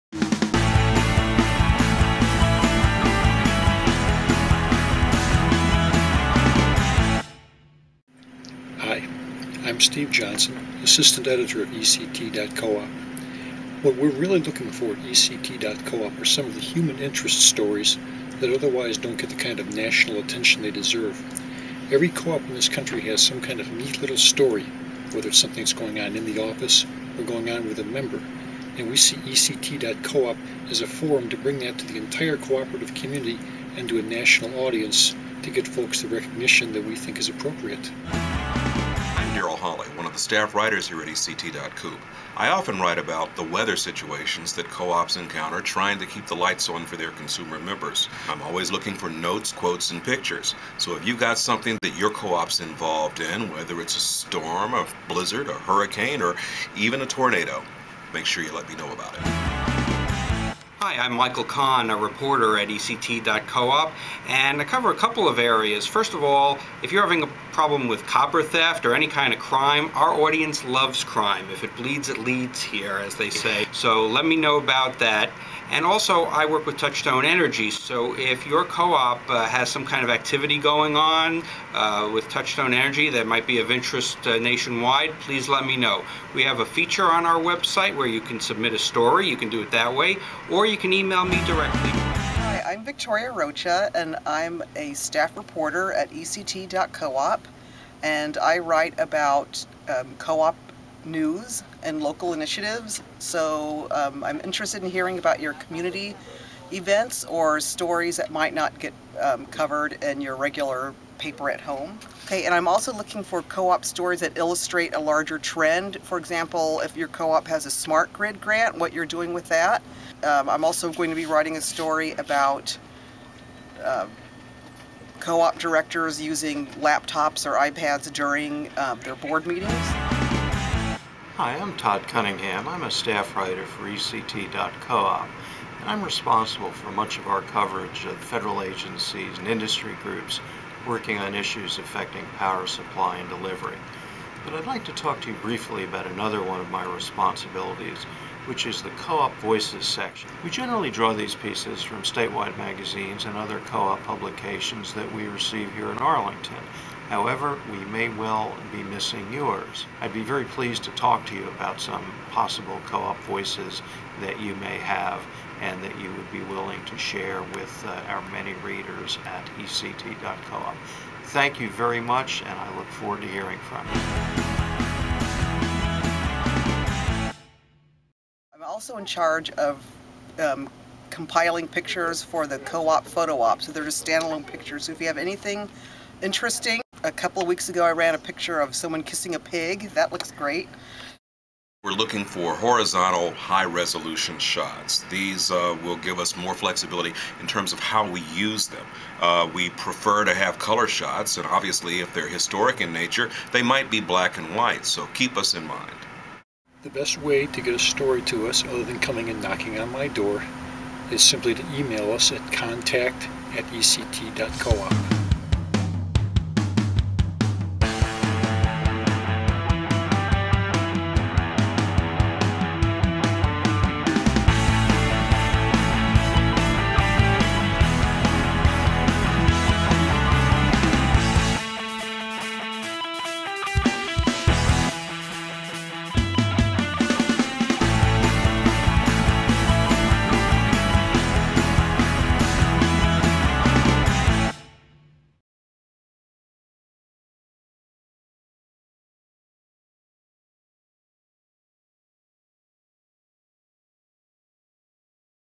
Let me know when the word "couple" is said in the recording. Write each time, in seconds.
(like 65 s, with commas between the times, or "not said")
64 s, 187 s.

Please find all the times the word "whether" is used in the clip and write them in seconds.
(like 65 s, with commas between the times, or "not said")
25 s, 53 s.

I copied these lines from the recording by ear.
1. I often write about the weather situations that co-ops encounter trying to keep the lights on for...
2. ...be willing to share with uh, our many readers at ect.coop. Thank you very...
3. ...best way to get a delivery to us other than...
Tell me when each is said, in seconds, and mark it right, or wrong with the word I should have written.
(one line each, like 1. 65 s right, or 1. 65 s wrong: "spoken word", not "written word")
1. 42 s right
2. 166 s right
3. 206 s wrong: "story", not "delivery".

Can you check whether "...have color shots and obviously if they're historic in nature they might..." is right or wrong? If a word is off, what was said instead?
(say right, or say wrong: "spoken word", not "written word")
right.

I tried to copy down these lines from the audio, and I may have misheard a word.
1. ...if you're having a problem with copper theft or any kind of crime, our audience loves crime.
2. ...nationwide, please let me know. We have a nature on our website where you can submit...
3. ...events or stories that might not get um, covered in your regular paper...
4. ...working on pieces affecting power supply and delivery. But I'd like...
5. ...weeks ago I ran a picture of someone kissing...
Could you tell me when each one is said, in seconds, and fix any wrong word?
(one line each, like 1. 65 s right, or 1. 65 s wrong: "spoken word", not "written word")
1. 66 s right
2. 84 s wrong: "feature", not "nature"
3. 106 s right
4. 140 s wrong: "issues", not "pieces"
5. 187 s right.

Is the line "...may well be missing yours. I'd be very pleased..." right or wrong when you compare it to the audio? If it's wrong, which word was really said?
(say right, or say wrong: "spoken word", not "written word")
right.